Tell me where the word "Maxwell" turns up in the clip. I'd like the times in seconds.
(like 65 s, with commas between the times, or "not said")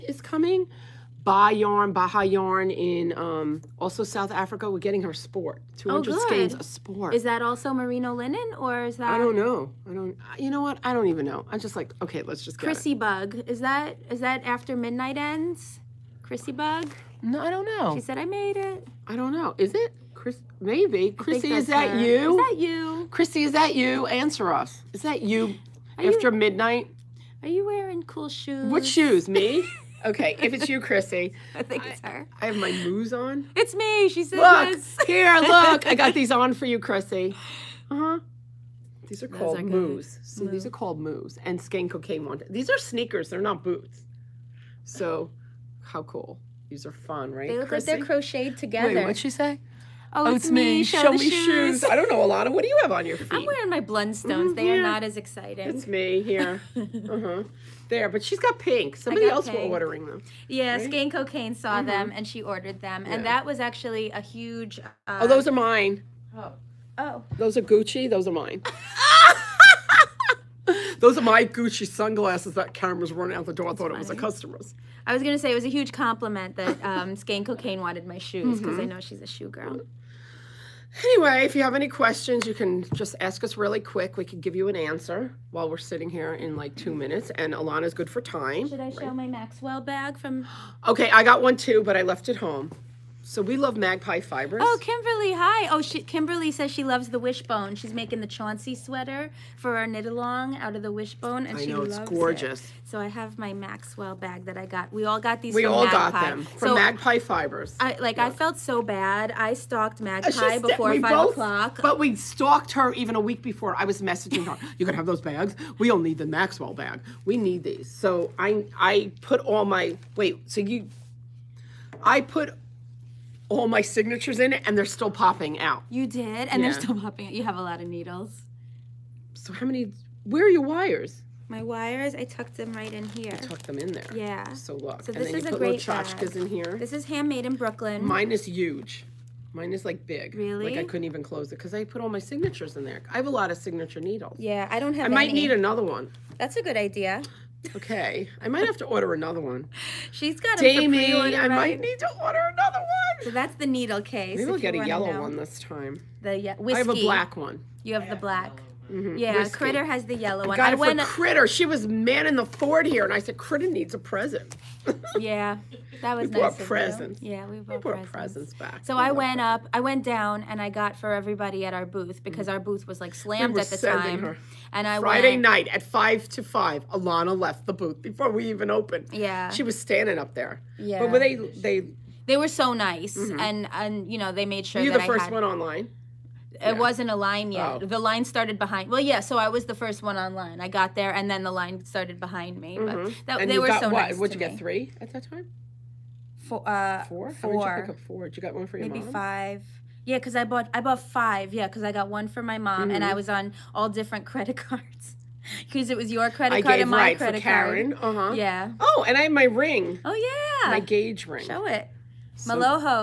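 89 s, 103 s, 116 s.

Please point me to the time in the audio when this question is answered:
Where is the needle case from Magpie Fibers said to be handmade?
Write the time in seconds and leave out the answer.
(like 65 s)
137 s.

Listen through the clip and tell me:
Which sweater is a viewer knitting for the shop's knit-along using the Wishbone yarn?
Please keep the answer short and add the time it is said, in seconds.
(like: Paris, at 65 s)
Chauncey, at 98 s.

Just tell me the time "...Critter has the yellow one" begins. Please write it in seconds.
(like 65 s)
159 s.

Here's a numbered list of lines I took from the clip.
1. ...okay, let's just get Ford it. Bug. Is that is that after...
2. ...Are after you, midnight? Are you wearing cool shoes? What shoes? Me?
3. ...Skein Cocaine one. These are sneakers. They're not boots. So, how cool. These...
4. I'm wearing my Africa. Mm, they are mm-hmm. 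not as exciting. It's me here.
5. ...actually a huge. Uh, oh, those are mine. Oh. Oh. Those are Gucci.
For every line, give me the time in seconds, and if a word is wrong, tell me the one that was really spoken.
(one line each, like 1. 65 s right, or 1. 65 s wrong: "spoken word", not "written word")
1. 12 s wrong: "Chrissy", not "Ford"
2. 25 s right
3. 41 s right
4. 53 s wrong: "Blundstones", not "Africa"
5. 63 s right.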